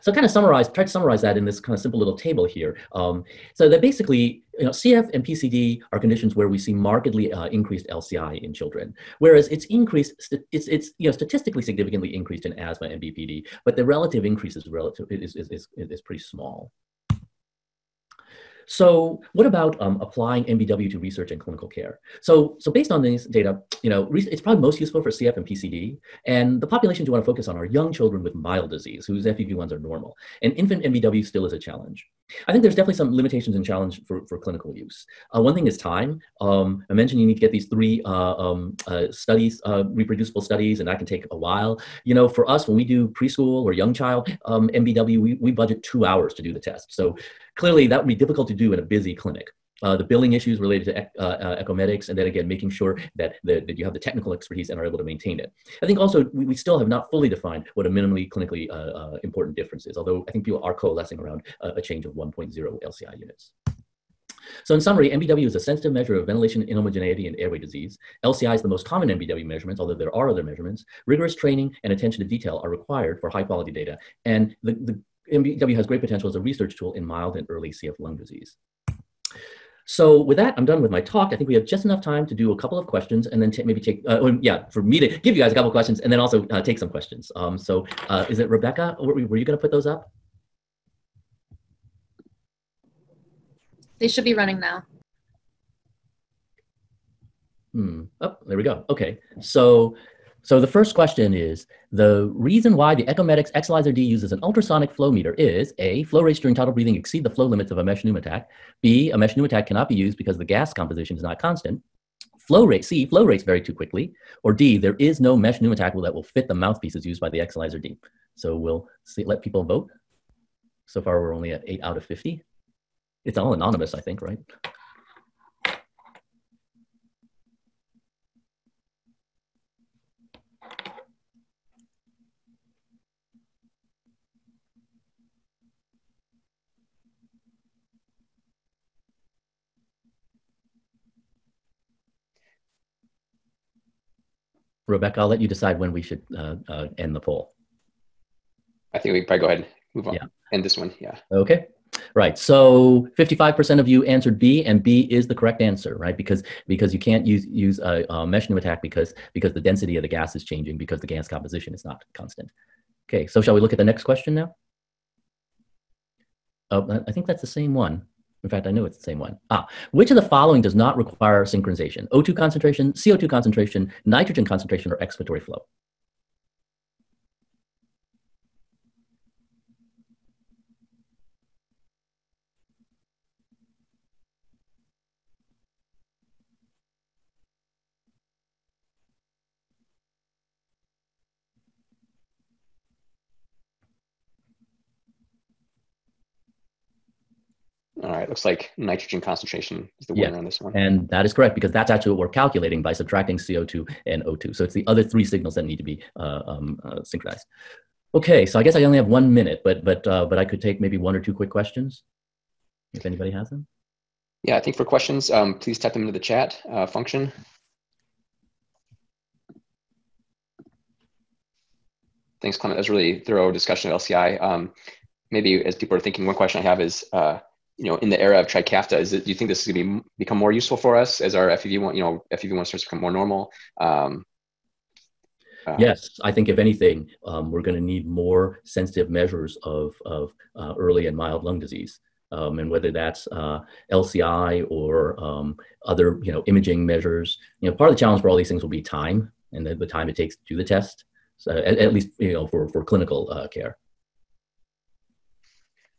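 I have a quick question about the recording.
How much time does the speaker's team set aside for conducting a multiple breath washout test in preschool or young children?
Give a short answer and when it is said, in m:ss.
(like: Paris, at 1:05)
2 hours, at 0:45.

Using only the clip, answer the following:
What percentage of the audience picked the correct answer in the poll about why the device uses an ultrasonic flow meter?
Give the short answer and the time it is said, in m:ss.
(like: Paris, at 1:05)
55%, at 2:33.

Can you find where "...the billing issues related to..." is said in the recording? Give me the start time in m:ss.
0:49.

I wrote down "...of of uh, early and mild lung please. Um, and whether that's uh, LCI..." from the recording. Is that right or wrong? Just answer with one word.
wrong.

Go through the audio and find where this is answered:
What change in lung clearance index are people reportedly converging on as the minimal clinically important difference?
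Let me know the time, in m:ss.
1:02.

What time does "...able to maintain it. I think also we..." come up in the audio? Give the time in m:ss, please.
0:54.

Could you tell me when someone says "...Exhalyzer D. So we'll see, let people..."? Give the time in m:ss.
1:57.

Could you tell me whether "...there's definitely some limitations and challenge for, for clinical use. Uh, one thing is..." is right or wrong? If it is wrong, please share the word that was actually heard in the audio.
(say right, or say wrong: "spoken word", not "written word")
right.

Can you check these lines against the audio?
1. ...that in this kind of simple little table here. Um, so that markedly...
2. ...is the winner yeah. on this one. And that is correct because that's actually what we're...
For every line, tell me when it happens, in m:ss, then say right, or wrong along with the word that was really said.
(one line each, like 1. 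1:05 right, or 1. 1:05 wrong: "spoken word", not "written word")
1. 0:01 wrong: "basically", not "markedly"
2. 3:19 right.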